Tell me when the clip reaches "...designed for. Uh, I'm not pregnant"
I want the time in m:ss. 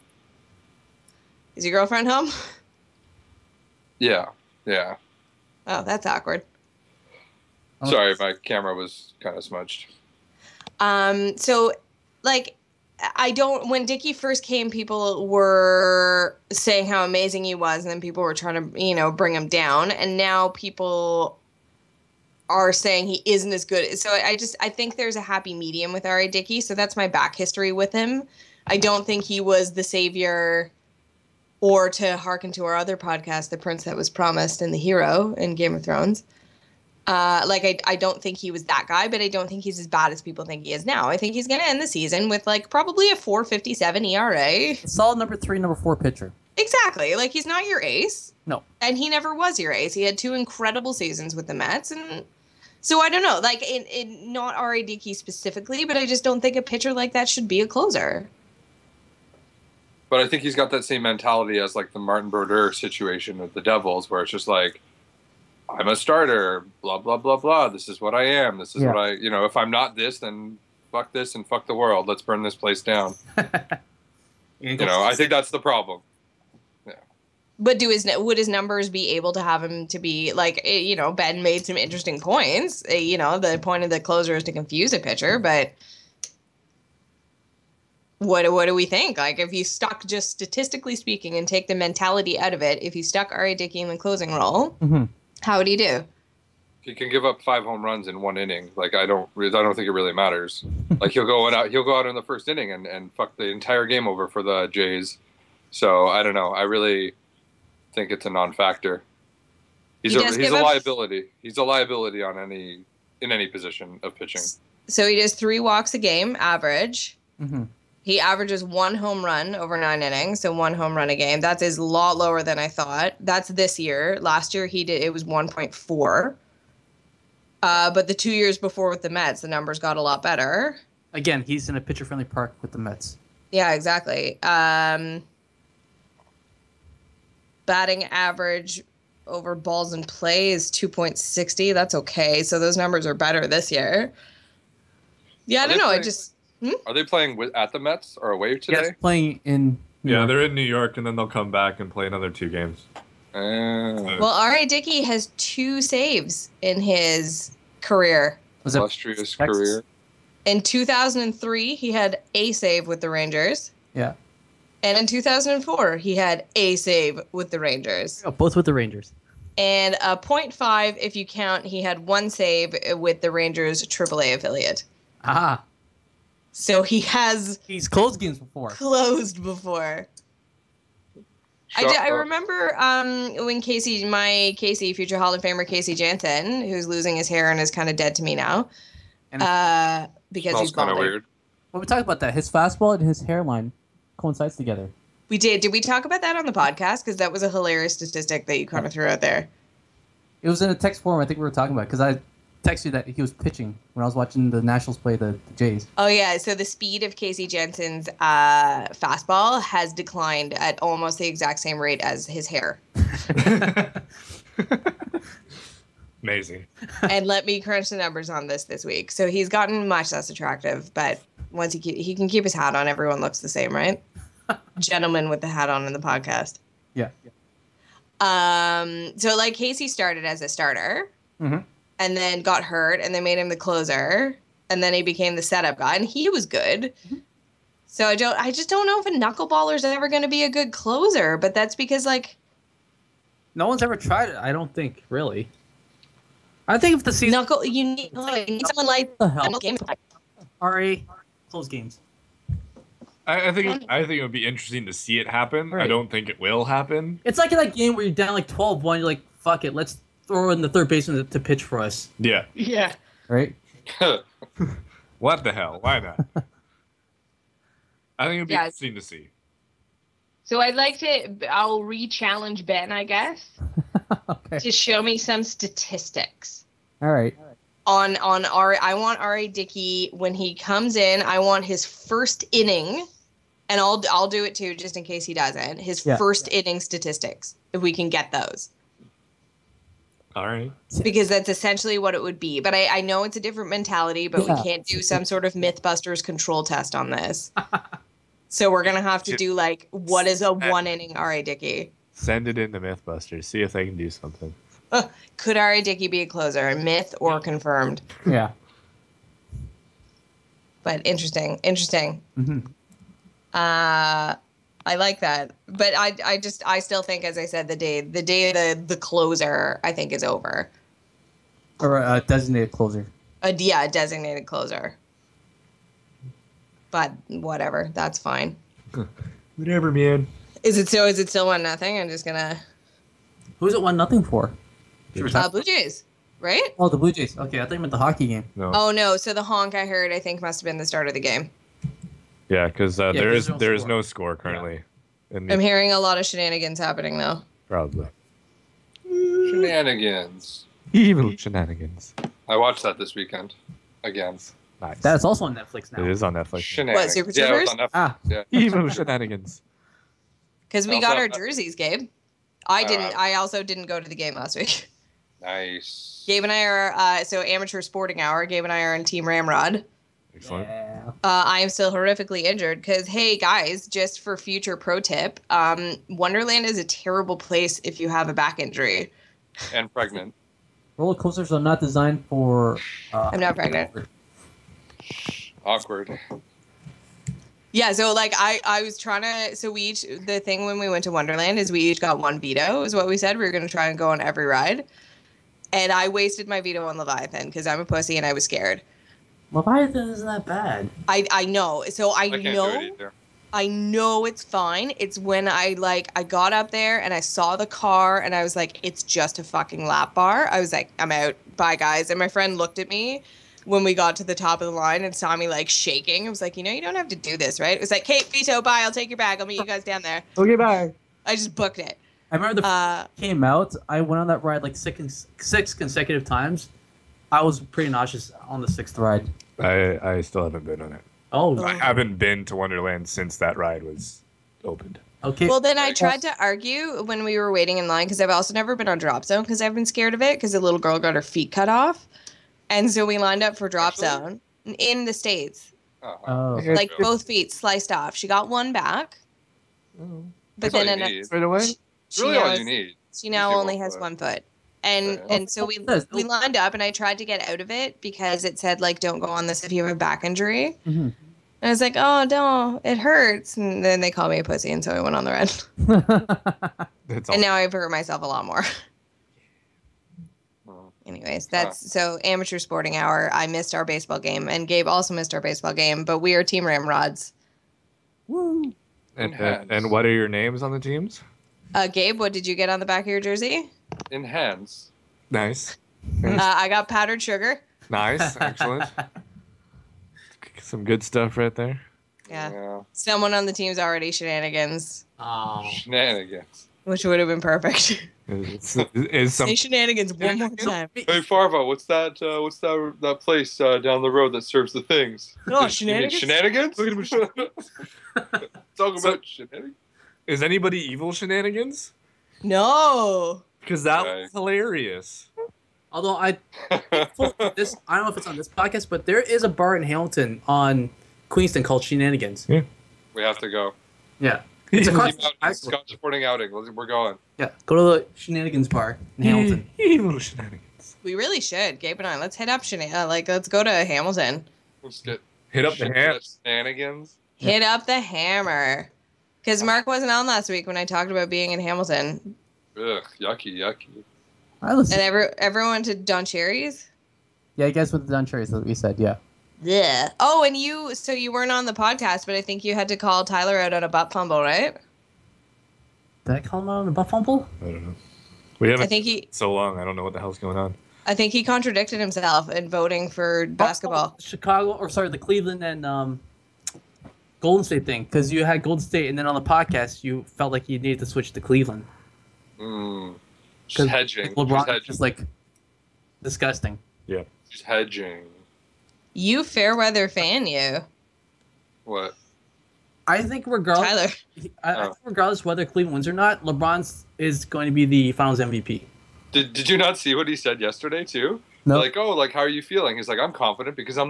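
6:21.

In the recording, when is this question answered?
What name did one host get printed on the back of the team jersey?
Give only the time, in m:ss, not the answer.
8:06.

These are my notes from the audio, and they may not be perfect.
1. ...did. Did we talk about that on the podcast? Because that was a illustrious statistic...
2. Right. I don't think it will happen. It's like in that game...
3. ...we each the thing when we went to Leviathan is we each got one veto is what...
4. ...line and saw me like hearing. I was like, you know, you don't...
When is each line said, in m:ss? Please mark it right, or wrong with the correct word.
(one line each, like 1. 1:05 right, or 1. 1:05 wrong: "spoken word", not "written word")
1. 3:15 wrong: "hilarious", not "illustrious"
2. 4:15 right
3. 6:29 wrong: "Wonderland", not "Leviathan"
4. 6:54 wrong: "shaking", not "hearing".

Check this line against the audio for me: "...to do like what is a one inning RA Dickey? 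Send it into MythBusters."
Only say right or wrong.
right.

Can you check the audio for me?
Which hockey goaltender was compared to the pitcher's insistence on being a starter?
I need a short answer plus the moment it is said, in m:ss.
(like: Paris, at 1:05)
Martin Brodeur, at 1:01.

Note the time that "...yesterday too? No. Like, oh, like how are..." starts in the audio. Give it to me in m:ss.
9:50.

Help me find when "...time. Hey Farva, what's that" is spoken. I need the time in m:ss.
8:20.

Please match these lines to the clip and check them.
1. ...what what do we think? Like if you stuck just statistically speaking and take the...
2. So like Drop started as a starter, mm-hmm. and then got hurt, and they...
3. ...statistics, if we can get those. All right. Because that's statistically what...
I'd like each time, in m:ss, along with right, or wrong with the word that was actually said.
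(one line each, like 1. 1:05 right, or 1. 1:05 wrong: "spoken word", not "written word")
1. 1:28 right
2. 3:49 wrong: "Casey", not "Drop"
3. 4:46 wrong: "essentially", not "statistically".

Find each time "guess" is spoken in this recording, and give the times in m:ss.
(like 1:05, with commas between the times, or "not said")
4:33, 9:07.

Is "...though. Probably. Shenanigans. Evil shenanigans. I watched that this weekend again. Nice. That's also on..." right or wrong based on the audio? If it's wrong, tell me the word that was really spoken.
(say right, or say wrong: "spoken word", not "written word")
right.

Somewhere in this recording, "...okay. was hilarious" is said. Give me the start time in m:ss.
8:34.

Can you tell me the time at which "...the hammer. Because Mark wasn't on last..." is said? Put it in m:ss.
8:57.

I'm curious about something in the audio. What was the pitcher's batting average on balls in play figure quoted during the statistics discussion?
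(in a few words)
2.60.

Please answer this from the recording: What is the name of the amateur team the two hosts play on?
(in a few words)
Team Ramrod.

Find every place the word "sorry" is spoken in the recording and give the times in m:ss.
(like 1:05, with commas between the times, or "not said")
0:07, 4:10, 9:24.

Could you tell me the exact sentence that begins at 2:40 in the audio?
In 2003, he had a save with the Rangers.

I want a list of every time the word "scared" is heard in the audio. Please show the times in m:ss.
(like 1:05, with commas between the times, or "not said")
6:38, 7:19.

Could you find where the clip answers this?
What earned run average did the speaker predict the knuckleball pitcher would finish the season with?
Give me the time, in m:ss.
0:43.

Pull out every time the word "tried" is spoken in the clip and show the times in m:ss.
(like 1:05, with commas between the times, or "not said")
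4:03, 7:15, 7:36.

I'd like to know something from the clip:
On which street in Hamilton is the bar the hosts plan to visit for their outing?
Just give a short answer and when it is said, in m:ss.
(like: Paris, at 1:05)
Queenston, at 8:41.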